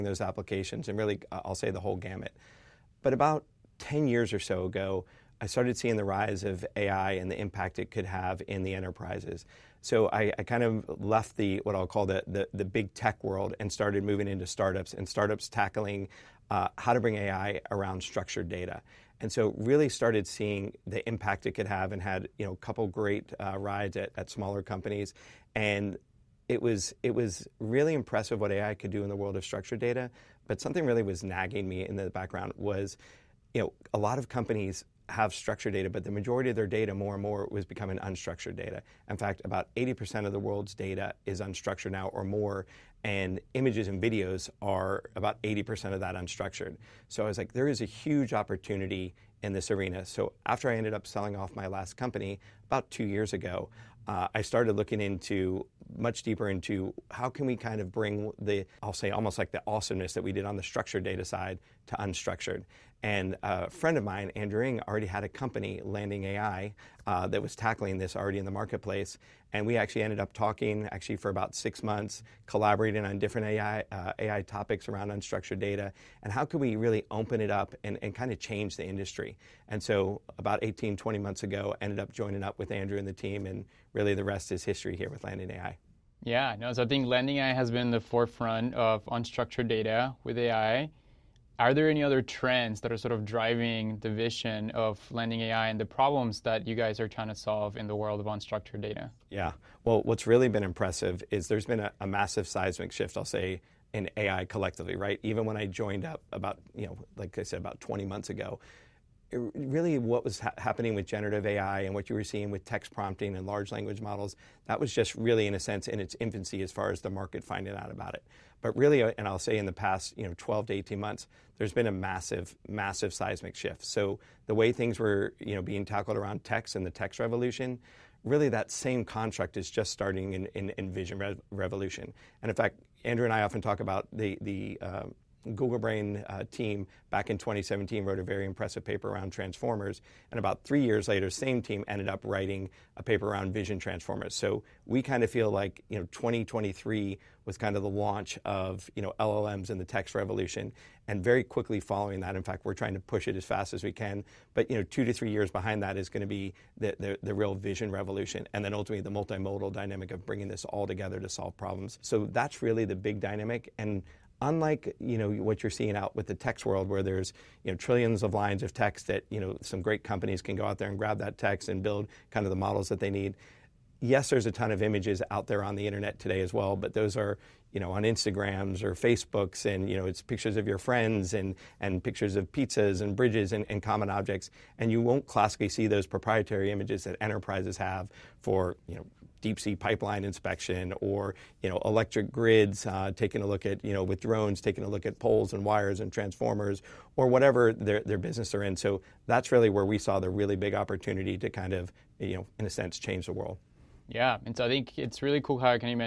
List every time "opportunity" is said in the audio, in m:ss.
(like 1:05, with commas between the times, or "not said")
0:48, 3:20.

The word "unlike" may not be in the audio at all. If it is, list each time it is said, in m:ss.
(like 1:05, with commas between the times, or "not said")
2:44.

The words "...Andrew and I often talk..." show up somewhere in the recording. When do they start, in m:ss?
2:13.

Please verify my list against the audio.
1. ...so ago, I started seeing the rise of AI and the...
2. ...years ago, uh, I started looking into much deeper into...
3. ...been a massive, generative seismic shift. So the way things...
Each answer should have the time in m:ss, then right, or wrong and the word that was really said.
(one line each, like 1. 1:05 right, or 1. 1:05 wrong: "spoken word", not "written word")
1. 0:04 right
2. 0:53 right
3. 2:01 wrong: "massive", not "generative".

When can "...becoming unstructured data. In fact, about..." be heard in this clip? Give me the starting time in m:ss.
0:37.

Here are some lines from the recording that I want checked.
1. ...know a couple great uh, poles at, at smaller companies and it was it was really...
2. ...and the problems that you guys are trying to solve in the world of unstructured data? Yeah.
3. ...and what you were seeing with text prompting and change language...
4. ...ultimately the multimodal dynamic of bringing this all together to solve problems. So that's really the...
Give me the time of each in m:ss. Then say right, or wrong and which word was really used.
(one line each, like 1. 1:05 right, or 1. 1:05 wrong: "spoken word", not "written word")
1. 0:22 wrong: "rides", not "poles"
2. 1:35 right
3. 1:51 wrong: "large", not "change"
4. 2:38 right.